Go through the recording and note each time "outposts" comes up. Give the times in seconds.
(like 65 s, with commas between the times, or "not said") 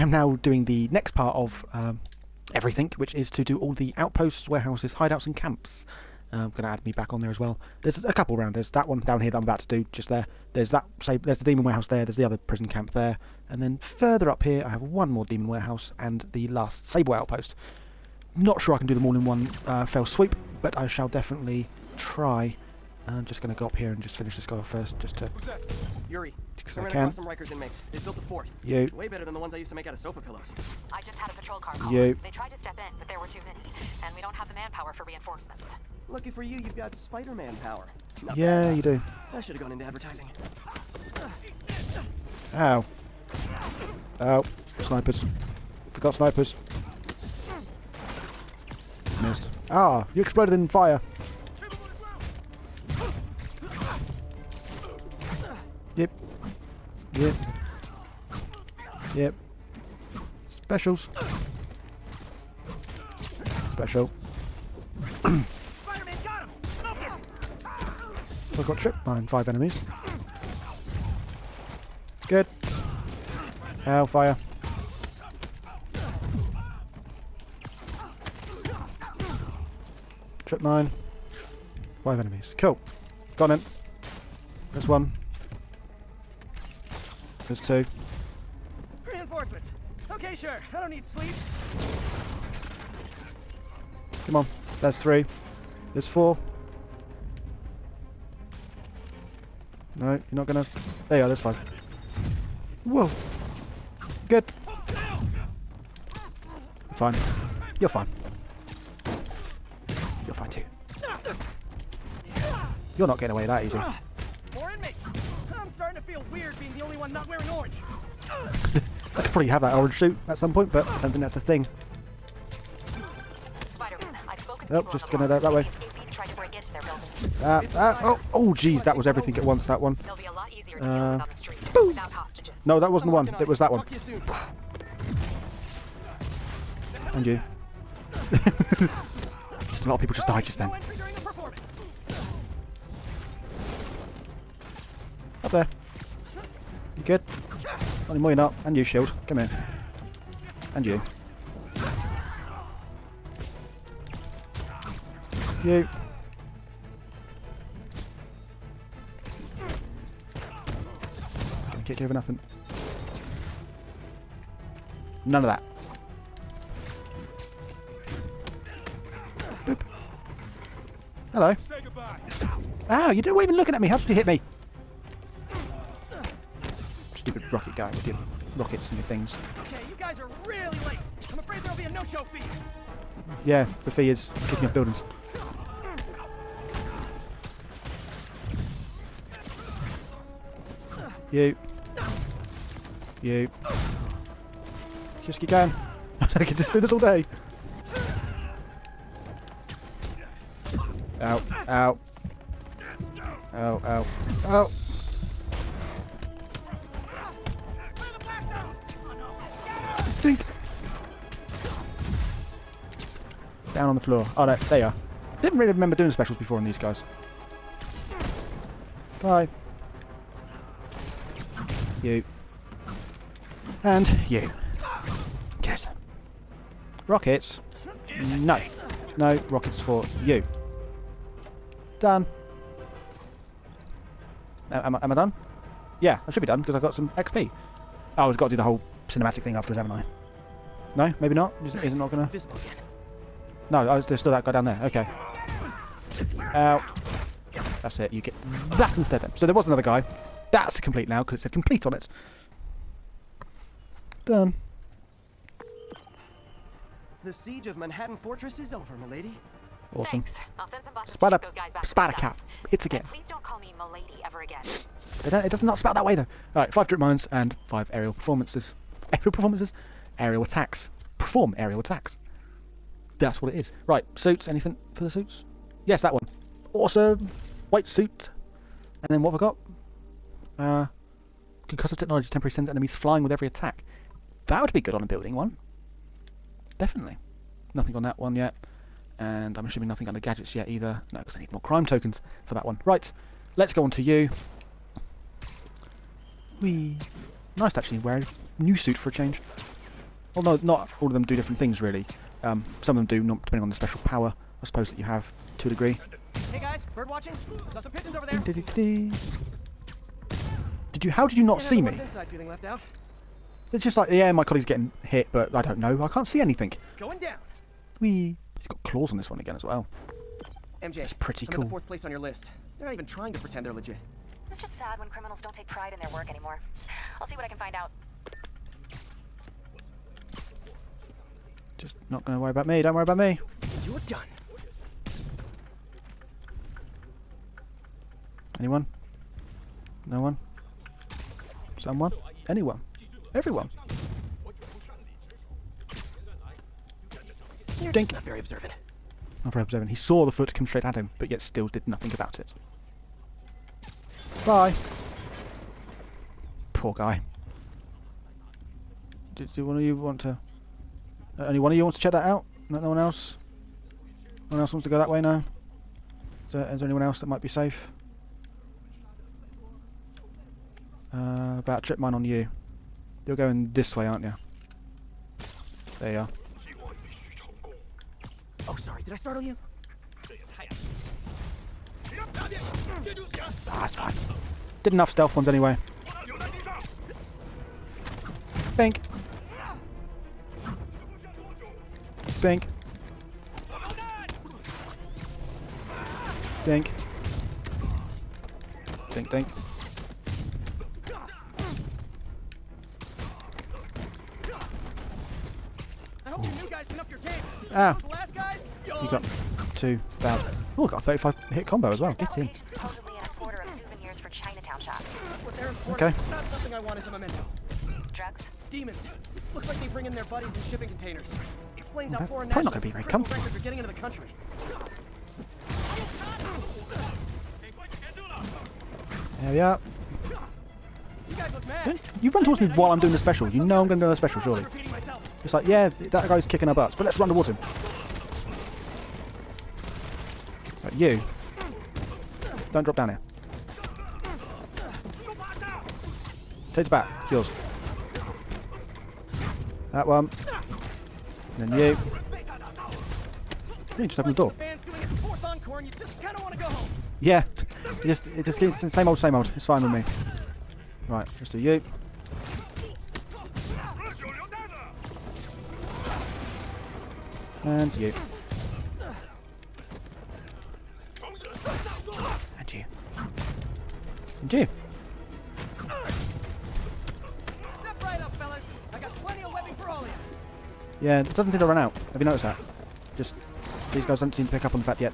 3 s, 17 s.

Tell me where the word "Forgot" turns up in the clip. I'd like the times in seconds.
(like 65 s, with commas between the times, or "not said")
45 s.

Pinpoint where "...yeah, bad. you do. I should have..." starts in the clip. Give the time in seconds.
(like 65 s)
38 s.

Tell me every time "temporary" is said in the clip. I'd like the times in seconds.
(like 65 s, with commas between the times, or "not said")
282 s.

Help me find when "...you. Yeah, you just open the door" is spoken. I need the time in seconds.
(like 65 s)
451 s.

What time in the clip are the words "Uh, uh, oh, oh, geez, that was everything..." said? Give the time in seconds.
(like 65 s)
127 s.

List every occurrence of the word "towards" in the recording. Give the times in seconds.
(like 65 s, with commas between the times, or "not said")
432 s, 437 s.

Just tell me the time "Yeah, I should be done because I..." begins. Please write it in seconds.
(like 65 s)
236 s.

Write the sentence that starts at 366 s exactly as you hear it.
So, is there anyone else that might be safe?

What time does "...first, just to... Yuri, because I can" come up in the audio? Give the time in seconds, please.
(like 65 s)
24 s.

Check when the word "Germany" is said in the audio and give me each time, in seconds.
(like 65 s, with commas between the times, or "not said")
not said.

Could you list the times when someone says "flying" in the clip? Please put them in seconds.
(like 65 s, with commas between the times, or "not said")
282 s.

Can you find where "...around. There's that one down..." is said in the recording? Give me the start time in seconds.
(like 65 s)
8 s.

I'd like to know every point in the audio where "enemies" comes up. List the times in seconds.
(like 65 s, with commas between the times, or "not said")
69 s, 82 s, 282 s.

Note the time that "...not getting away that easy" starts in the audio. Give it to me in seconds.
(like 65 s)
113 s.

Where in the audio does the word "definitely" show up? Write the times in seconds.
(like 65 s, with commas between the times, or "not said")
21 s, 286 s.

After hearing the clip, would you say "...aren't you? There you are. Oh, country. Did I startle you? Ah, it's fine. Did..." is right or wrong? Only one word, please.
wrong.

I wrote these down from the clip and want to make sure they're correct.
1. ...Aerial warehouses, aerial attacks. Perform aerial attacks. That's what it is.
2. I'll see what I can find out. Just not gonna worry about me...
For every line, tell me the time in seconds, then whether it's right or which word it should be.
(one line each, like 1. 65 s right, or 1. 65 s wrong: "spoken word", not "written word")
1. 269 s wrong: "performances", not "warehouses"
2. 327 s right.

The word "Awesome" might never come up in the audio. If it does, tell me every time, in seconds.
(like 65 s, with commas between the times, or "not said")
259 s, 276 s.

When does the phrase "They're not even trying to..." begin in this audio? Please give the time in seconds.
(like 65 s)
322 s.